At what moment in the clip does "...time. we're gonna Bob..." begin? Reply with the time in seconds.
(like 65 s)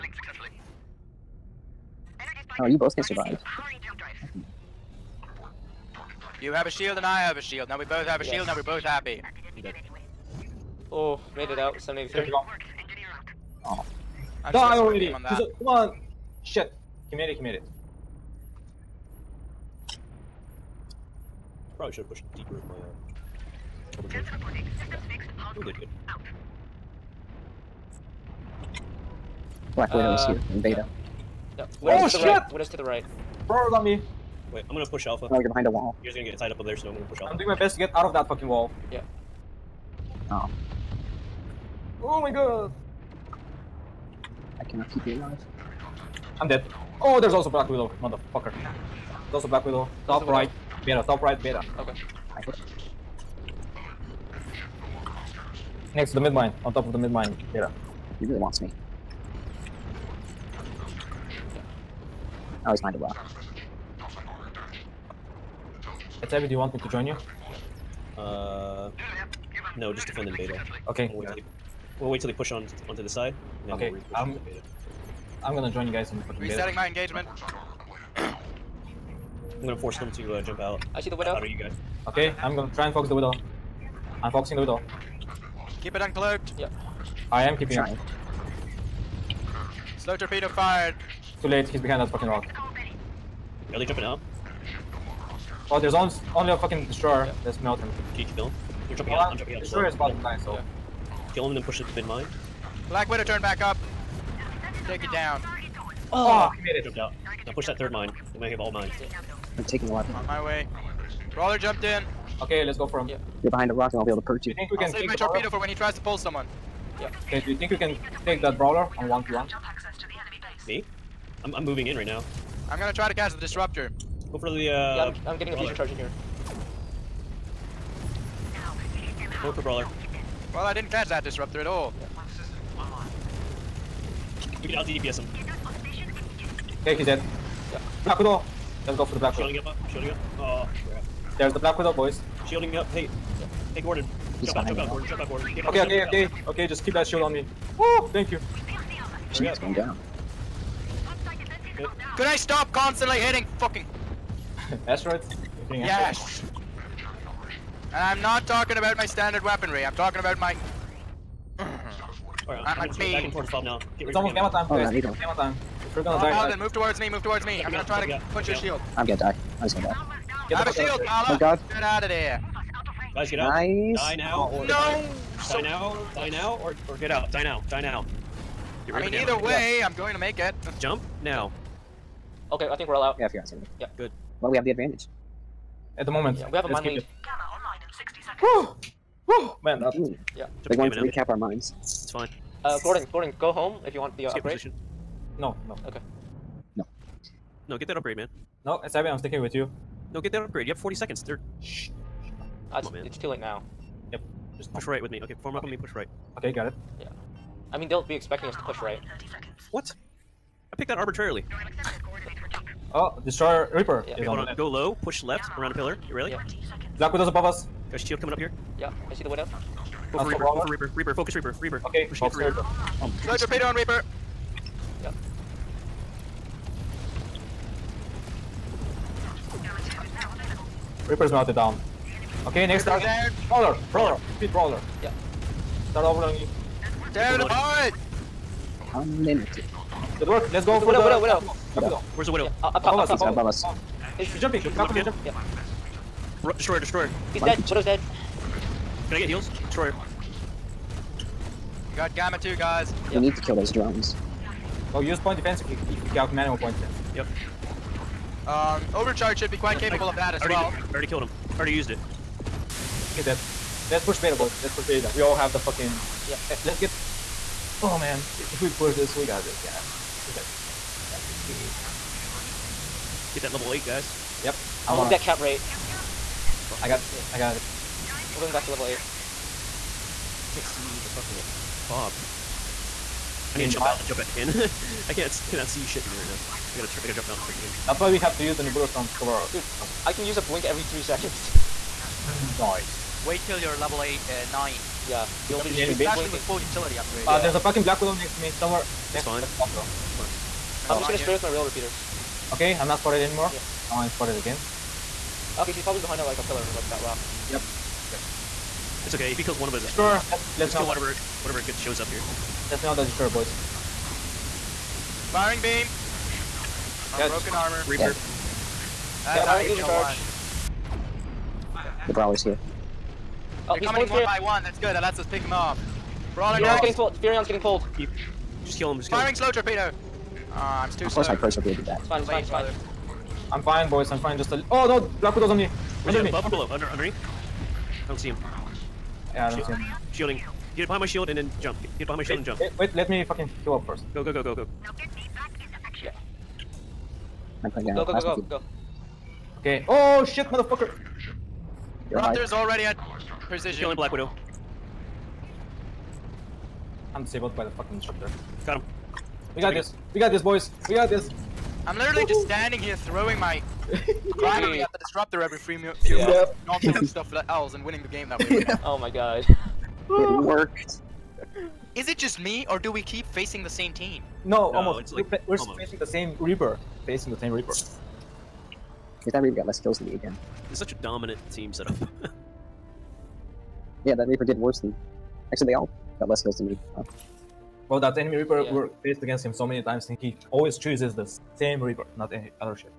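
165 s.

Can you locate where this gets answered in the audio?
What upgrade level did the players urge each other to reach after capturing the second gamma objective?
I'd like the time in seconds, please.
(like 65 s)
273 s.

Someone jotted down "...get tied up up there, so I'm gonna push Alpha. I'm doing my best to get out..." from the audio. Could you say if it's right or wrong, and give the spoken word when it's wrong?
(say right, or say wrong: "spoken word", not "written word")
right.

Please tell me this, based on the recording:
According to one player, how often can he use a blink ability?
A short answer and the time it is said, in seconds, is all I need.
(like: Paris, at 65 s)
every 3 seconds, at 290 s.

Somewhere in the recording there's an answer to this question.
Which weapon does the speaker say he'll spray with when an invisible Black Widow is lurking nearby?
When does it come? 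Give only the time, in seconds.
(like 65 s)
301 s.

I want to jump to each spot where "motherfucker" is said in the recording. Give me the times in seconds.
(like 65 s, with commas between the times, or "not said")
48 s, 350 s.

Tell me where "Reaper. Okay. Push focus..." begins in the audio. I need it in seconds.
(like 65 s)
221 s.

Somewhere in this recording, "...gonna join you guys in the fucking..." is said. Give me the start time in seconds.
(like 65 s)
75 s.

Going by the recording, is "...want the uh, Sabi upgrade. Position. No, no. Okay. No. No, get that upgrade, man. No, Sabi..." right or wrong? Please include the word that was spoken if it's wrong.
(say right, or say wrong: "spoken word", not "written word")
wrong: "Skip", not "Sabi".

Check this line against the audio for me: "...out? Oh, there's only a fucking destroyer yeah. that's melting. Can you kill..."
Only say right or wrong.
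right.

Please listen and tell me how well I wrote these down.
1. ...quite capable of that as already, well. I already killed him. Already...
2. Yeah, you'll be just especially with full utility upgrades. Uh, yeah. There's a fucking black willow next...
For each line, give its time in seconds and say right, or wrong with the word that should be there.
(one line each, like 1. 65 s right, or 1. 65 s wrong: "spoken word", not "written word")
1. 259 s right
2. 295 s right.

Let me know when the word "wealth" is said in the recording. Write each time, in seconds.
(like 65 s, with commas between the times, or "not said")
not said.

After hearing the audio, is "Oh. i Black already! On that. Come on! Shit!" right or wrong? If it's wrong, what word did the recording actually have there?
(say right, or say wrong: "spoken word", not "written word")
wrong: "Die", not "Black".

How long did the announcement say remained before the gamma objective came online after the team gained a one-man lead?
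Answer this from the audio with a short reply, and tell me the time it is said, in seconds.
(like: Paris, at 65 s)
60 seconds, at 187 s.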